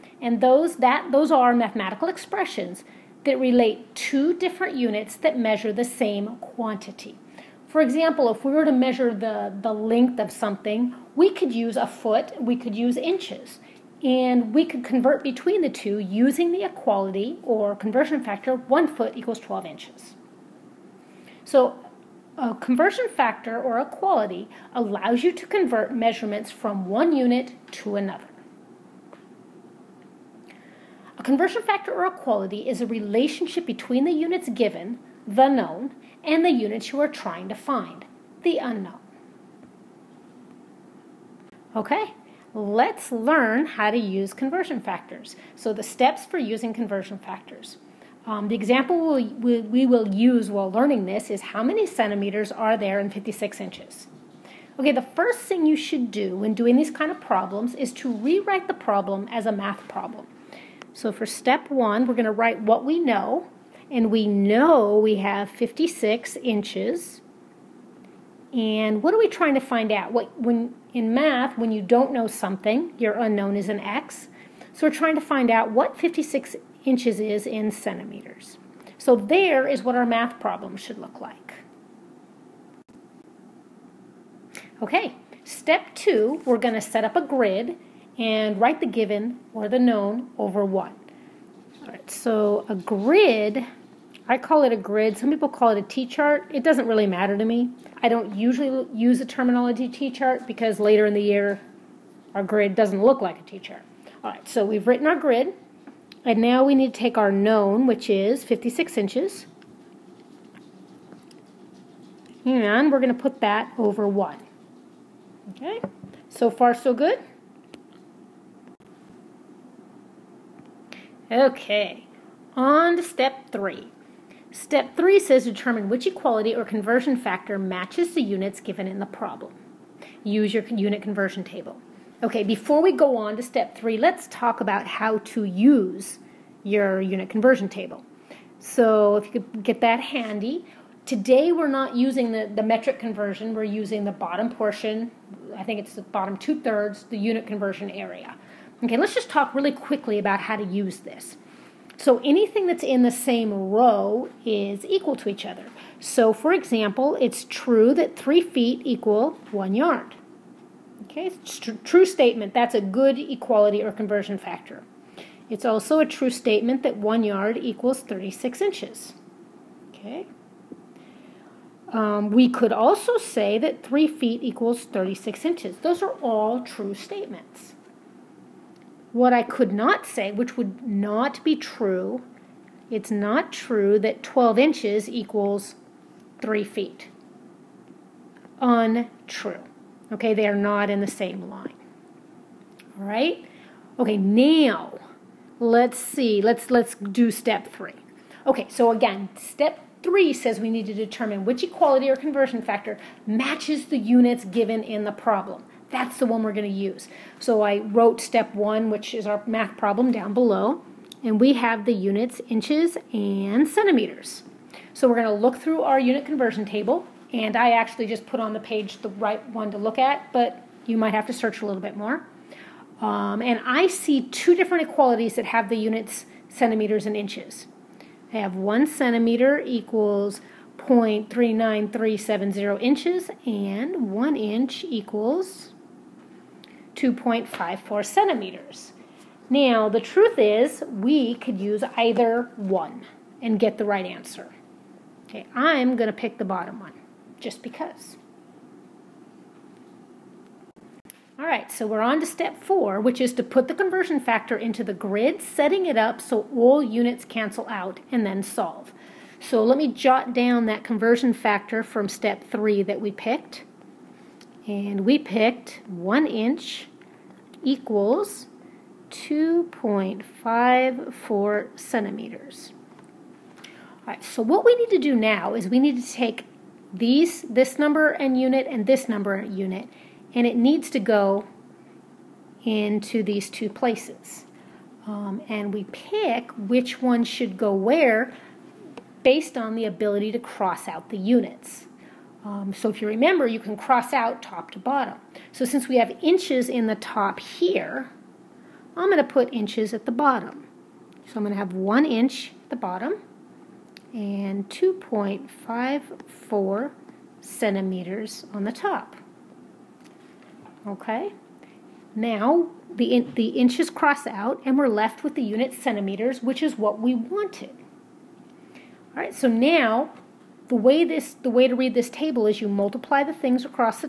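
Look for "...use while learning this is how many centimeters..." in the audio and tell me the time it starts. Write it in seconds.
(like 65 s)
50 s.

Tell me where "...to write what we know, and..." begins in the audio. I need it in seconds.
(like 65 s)
62 s.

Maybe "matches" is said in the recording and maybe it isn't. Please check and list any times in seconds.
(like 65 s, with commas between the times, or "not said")
127 s, 203 s.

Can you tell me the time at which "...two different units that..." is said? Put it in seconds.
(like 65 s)
3 s.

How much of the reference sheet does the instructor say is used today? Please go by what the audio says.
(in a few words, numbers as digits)
bottom two thirds.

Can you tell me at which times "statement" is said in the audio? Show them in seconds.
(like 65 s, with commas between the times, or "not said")
162 s, 166 s, 176 s.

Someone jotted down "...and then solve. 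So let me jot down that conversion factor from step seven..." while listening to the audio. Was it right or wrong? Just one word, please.
wrong.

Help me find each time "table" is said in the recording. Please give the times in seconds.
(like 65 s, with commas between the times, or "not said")
131 s, 137 s, 216 s, 322 s.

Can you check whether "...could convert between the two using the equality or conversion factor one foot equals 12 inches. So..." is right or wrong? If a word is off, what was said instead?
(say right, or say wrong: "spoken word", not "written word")
right.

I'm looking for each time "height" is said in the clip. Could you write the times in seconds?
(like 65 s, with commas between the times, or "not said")
not said.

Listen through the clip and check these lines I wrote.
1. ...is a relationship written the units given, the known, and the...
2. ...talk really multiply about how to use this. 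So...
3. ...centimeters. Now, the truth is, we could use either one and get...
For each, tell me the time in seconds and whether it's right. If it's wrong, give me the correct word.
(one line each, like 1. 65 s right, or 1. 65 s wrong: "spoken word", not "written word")
1. 32 s wrong: "between", not "written"
2. 149 s wrong: "quickly", not "multiply"
3. 238 s right.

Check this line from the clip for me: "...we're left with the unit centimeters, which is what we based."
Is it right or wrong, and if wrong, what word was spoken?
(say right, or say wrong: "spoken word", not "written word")
wrong: "wanted", not "based".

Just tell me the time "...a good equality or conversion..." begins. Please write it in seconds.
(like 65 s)
162 s.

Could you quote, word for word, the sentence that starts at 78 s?
So there is what our math problem should look like.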